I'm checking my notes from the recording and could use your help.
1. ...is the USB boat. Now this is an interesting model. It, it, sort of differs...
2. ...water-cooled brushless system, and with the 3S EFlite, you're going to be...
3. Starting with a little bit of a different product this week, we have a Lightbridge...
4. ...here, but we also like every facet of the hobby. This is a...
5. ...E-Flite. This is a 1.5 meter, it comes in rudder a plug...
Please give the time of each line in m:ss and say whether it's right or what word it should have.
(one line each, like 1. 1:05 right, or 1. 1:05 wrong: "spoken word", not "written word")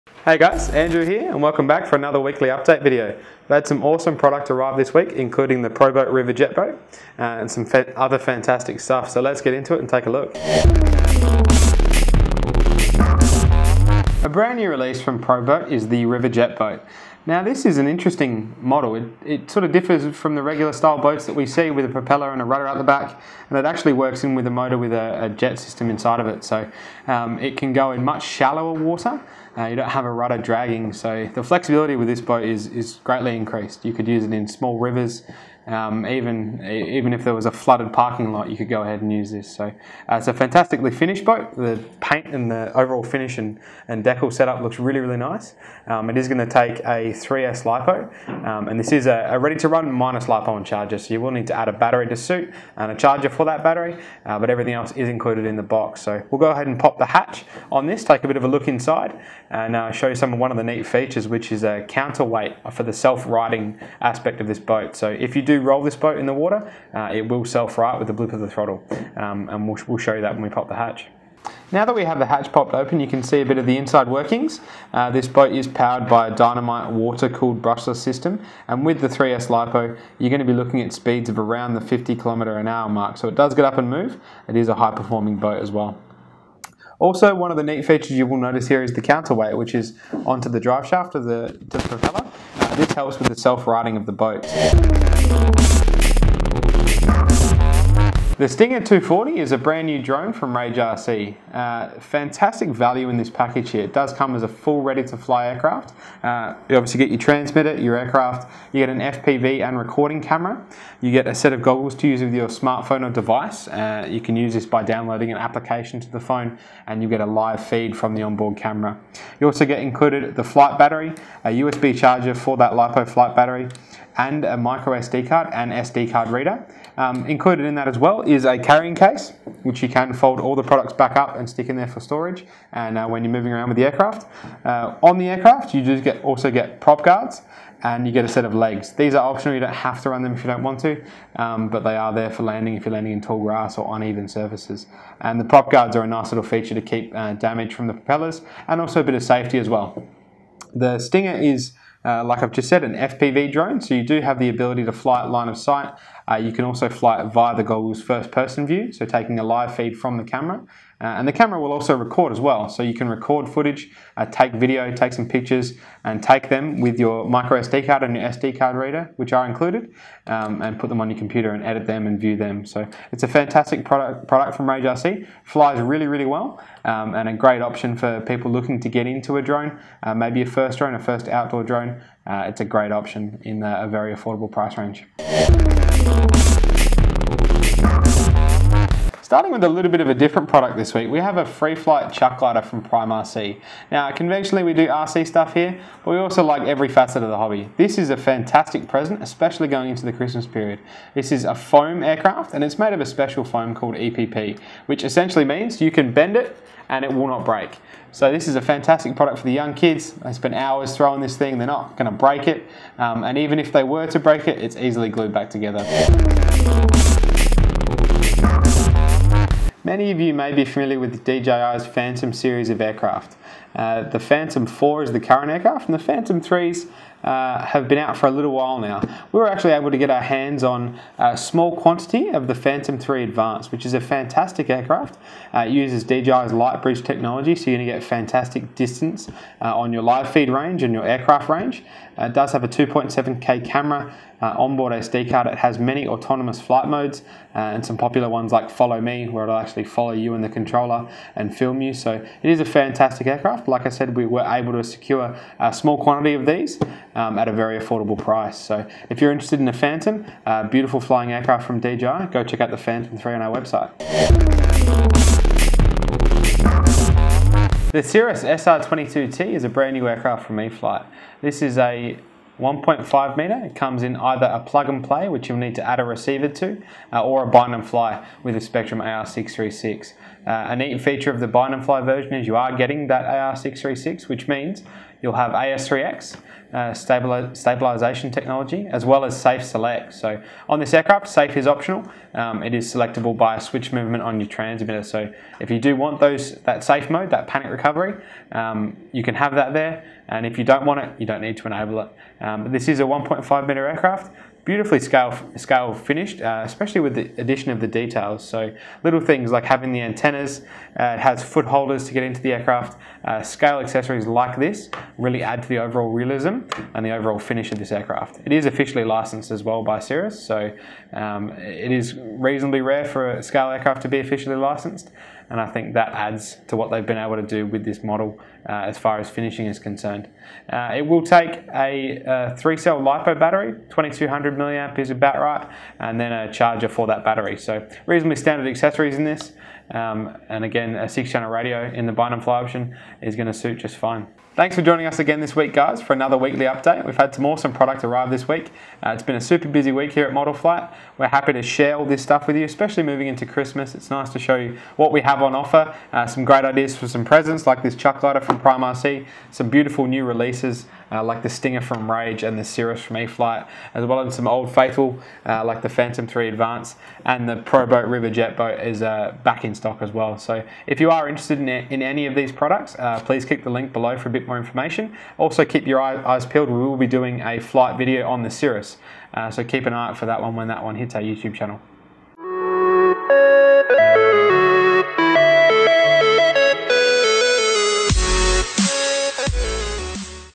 1. 0:15 wrong: "Riverjet", not "USB"
2. 1:16 wrong: "LiPo", not "EFlite"
3. 3:09 wrong: "Free", not "Lightbridge"
4. 3:15 right
5. 4:30 wrong: "either", not "rudder".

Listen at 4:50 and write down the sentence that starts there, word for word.
So on this aircraft, Safe is optional.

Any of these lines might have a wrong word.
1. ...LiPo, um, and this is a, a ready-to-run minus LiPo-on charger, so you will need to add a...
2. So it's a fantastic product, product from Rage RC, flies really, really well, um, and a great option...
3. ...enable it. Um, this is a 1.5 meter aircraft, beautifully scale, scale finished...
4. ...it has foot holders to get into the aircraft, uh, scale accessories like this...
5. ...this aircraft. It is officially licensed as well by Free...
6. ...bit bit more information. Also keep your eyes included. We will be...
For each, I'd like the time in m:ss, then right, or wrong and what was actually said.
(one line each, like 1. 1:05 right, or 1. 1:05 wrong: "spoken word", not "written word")
1. 0:47 right
2. 2:52 right
3. 5:01 right
4. 5:11 right
5. 5:17 wrong: "Cirrus", not "Free"
6. 6:14 wrong: "peeled", not "included".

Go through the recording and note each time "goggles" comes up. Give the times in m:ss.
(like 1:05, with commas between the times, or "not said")
1:51, 2:37.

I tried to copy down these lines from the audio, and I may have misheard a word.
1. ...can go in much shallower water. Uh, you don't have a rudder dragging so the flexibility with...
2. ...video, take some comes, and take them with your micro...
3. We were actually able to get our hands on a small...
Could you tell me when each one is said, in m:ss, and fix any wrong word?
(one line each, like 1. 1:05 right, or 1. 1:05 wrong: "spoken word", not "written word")
1. 0:27 right
2. 2:44 wrong: "pictures", not "comes"
3. 3:49 right.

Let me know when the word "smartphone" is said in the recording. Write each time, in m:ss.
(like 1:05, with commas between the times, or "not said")
1:52.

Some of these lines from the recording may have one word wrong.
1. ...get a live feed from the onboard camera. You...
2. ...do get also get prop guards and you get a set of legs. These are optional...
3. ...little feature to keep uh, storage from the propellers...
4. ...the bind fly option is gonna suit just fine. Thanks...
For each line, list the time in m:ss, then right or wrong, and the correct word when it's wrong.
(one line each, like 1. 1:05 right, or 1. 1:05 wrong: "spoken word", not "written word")
1. 1:57 right
2. 2:15 right
3. 2:26 wrong: "damage", not "storage"
4. 5:42 right.